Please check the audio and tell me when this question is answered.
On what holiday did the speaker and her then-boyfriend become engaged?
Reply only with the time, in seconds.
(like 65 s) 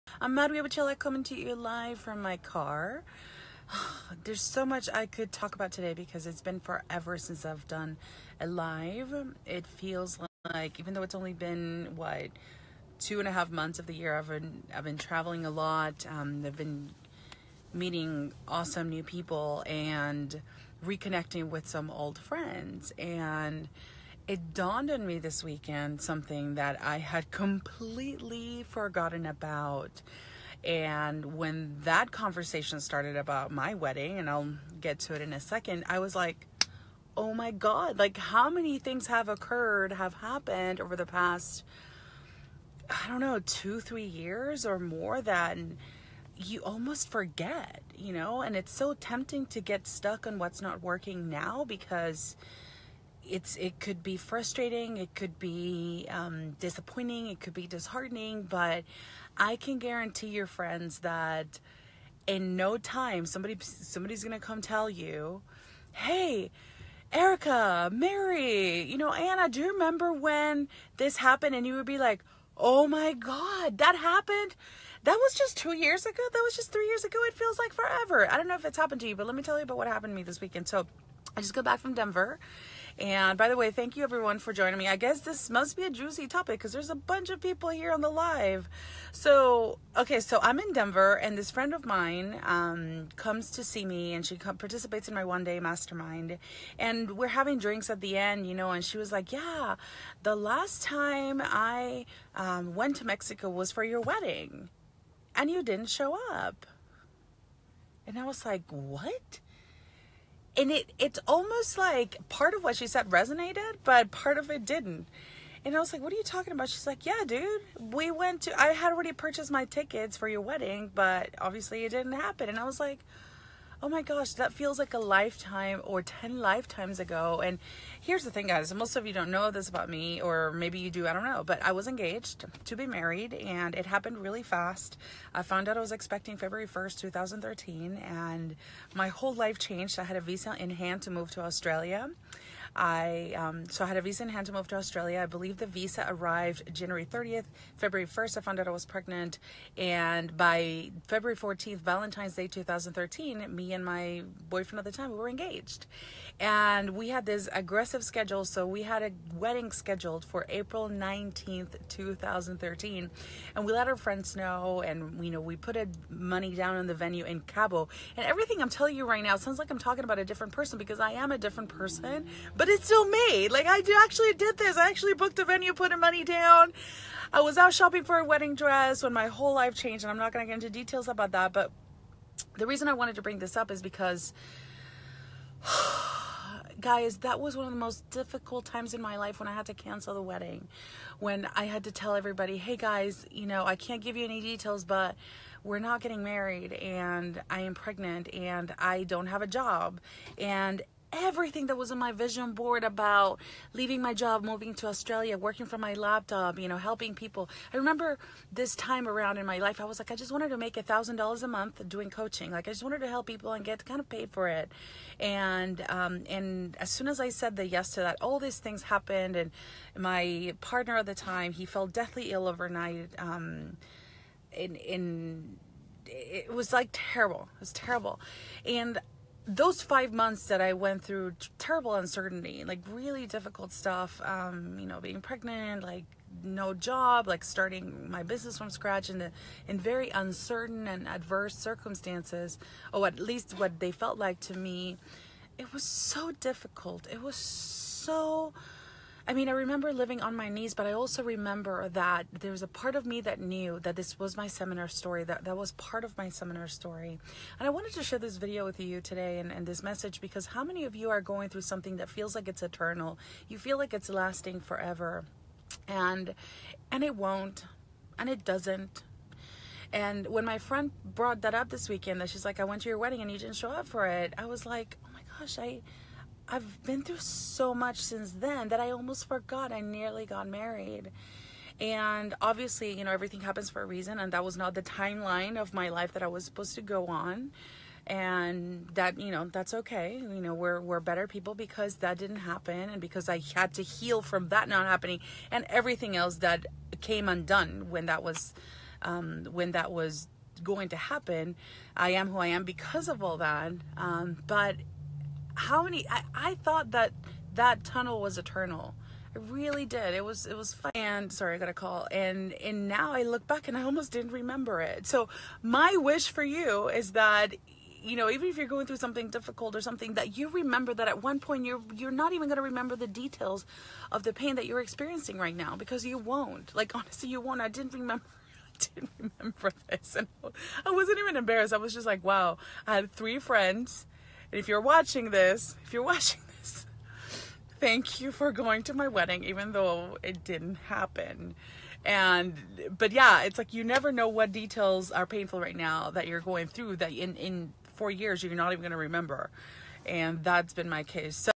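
151 s.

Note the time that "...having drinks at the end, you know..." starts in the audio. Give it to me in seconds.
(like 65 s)
97 s.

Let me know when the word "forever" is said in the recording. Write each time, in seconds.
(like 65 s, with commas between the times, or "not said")
6 s, 77 s, 264 s.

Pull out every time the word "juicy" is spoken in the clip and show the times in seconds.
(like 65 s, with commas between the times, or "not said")
85 s.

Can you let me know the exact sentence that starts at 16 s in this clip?
Um, I've been meeting awesome new people and reconnecting with some old friends.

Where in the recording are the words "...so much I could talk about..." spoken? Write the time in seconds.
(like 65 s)
4 s.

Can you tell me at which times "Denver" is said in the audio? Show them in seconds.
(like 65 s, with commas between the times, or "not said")
81 s, 90 s.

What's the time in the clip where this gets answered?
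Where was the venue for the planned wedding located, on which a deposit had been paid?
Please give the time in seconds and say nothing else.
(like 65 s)
165 s.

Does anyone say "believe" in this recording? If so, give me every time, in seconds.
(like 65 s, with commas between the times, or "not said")
145 s.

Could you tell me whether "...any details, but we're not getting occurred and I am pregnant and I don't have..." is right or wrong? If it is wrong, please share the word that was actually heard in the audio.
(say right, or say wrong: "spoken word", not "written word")
wrong: "married", not "occurred".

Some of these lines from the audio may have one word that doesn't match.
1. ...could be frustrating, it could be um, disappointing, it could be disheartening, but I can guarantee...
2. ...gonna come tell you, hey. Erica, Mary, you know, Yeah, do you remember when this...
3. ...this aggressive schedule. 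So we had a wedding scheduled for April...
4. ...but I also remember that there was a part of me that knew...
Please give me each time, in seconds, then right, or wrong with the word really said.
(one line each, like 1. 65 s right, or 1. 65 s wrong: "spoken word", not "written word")
1. 53 s right
2. 64 s wrong: "Anna", not "Yeah"
3. 157 s right
4. 250 s right.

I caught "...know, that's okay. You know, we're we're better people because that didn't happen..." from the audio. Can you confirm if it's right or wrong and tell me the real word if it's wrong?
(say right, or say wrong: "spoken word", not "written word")
right.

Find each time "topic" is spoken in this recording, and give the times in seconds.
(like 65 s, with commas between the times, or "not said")
86 s.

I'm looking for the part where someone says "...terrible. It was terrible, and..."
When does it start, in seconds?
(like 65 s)
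226 s.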